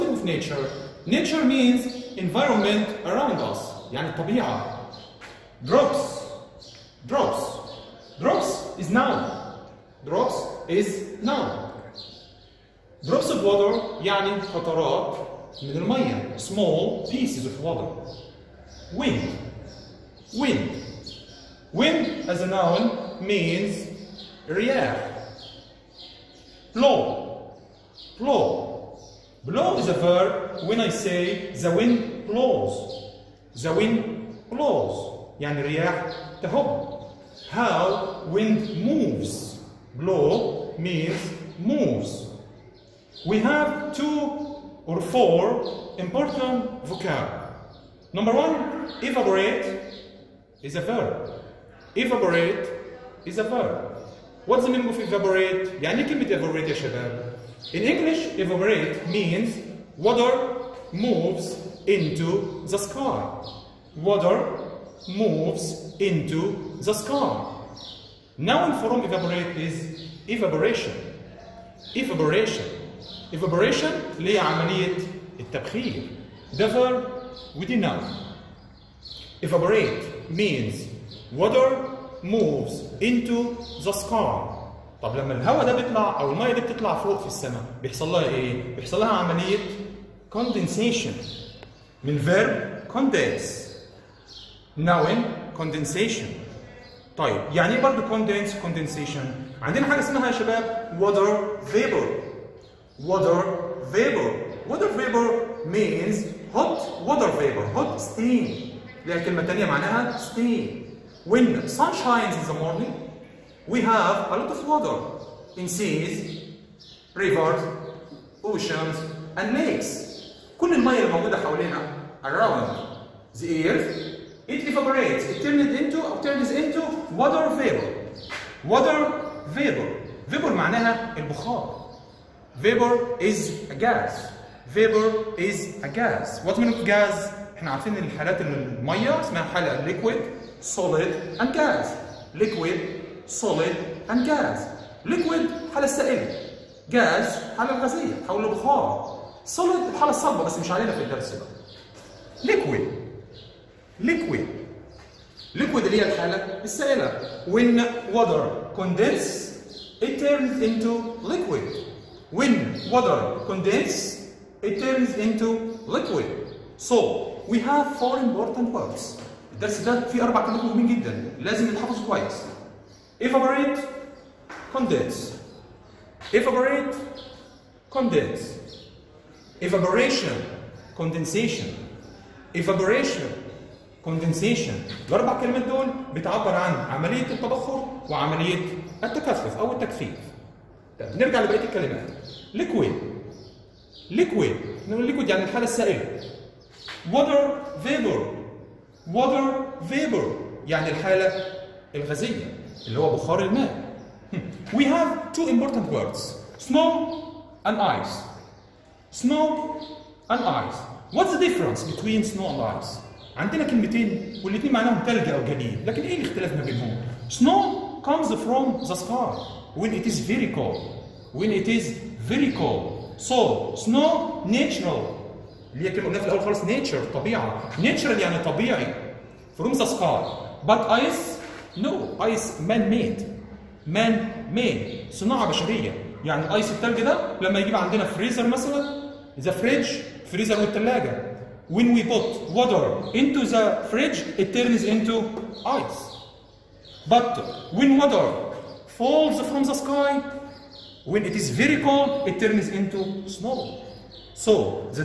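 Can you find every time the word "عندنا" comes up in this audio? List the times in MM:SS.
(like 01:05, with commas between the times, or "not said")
01:39, 03:33, 03:57.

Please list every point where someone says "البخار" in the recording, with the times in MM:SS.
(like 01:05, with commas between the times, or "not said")
02:11, 02:28.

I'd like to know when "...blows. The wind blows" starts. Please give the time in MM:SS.
00:32.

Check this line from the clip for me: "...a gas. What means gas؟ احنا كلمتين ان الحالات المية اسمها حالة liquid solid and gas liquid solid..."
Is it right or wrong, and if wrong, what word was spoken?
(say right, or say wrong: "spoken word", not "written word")
wrong: "عارفين", not "كلمتين".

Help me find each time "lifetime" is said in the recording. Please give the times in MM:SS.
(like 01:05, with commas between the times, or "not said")
not said.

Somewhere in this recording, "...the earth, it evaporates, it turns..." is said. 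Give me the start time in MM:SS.
02:03.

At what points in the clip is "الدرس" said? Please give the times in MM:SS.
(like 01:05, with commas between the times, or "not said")
02:31, 02:49.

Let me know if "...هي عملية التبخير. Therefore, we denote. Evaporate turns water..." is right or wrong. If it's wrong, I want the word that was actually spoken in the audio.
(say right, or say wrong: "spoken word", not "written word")
wrong: "means", not "turns".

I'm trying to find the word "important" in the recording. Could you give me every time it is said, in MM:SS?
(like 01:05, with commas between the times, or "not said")
00:45, 02:48, 03:25.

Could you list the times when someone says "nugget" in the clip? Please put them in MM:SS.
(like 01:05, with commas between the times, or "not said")
not said.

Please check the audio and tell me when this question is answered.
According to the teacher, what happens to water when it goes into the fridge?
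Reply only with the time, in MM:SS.
04:04.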